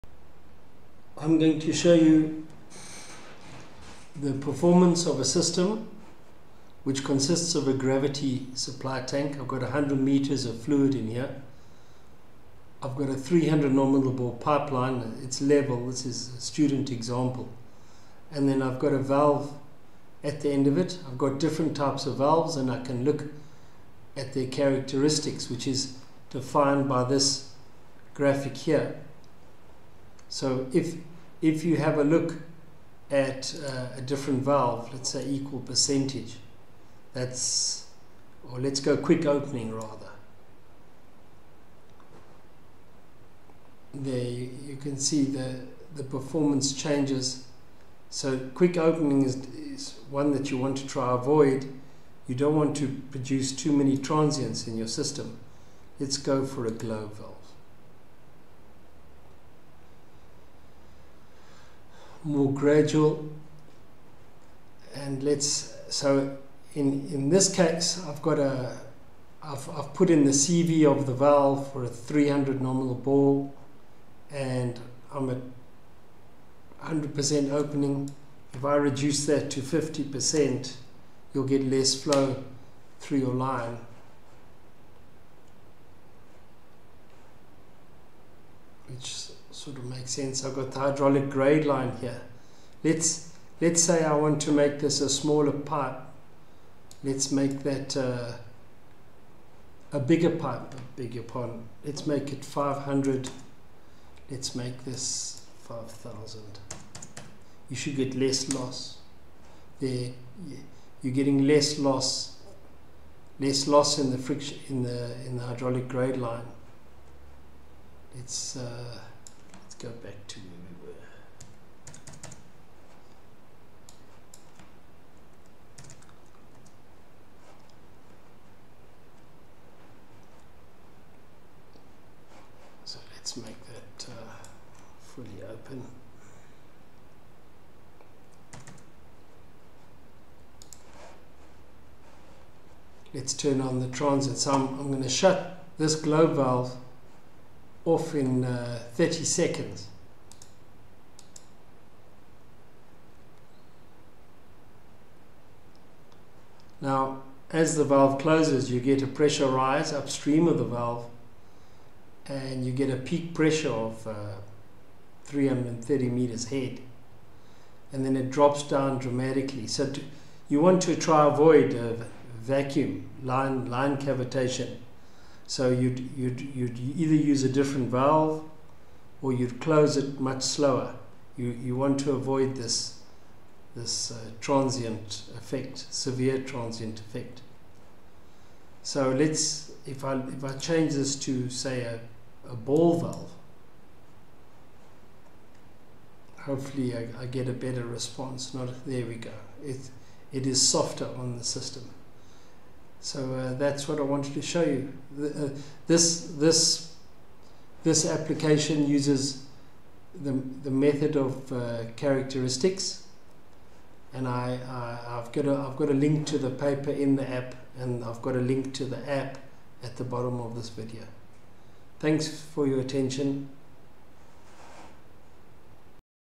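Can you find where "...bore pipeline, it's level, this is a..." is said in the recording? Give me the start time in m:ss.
0:14.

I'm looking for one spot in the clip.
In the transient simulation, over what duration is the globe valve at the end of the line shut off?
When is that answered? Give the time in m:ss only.
2:28.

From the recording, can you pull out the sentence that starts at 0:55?
Let's go for a globe valve.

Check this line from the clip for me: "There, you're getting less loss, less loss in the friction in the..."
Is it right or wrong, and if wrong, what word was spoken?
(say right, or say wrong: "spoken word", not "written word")
right.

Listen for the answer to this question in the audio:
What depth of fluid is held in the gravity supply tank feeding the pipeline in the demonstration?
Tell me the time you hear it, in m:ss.
0:09.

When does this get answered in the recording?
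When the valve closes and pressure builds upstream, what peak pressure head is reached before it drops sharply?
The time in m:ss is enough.
2:45.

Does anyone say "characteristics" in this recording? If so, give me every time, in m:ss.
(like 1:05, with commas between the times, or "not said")
0:24, 3:31.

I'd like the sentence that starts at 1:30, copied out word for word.
I've got the hydraulic grade line here.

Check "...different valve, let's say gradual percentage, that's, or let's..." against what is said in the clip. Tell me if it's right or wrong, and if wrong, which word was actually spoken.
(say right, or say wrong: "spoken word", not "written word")
wrong: "equal", not "gradual".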